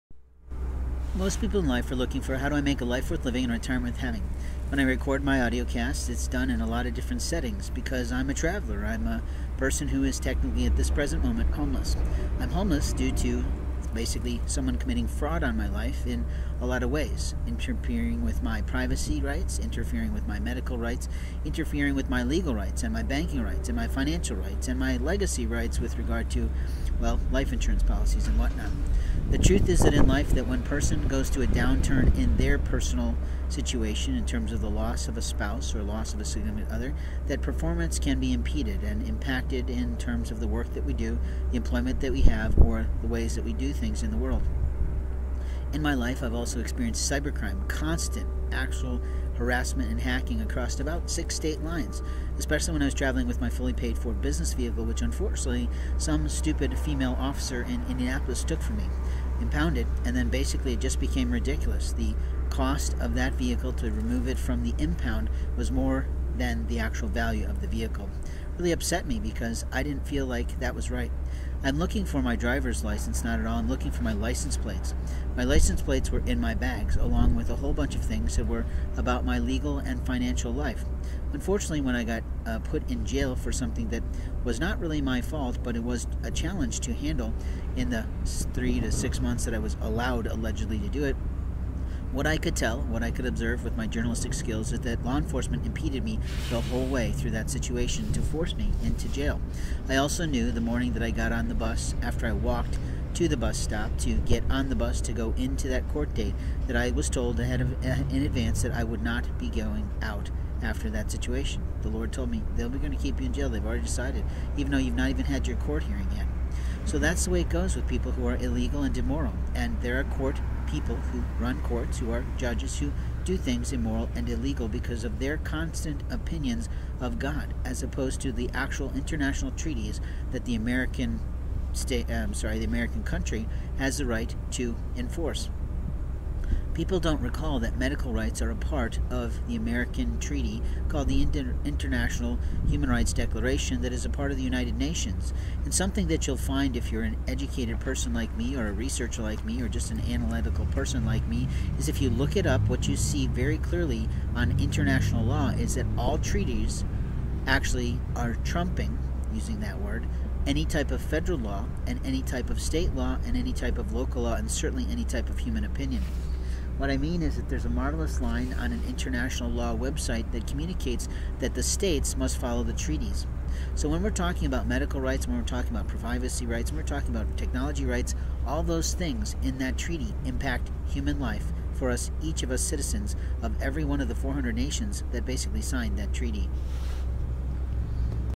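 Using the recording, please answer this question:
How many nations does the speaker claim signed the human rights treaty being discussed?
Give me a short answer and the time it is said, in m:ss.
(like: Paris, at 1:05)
400, at 3:04.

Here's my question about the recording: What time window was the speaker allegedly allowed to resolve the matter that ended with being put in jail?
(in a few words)
3 to 6 months.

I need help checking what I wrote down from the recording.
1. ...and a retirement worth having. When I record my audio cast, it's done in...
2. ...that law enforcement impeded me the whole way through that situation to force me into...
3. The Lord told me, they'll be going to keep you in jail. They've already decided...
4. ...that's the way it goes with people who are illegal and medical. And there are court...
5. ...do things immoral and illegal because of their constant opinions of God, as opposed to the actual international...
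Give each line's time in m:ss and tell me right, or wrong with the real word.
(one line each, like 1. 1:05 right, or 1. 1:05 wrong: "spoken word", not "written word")
1. 0:03 right
2. 1:34 right
3. 1:51 right
4. 1:56 wrong: "immoral", not "medical"
5. 2:03 right.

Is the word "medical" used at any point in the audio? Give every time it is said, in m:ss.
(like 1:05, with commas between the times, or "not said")
0:20, 2:17, 2:54.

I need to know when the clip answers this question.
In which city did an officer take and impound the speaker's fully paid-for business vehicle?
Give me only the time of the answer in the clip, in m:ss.
0:57.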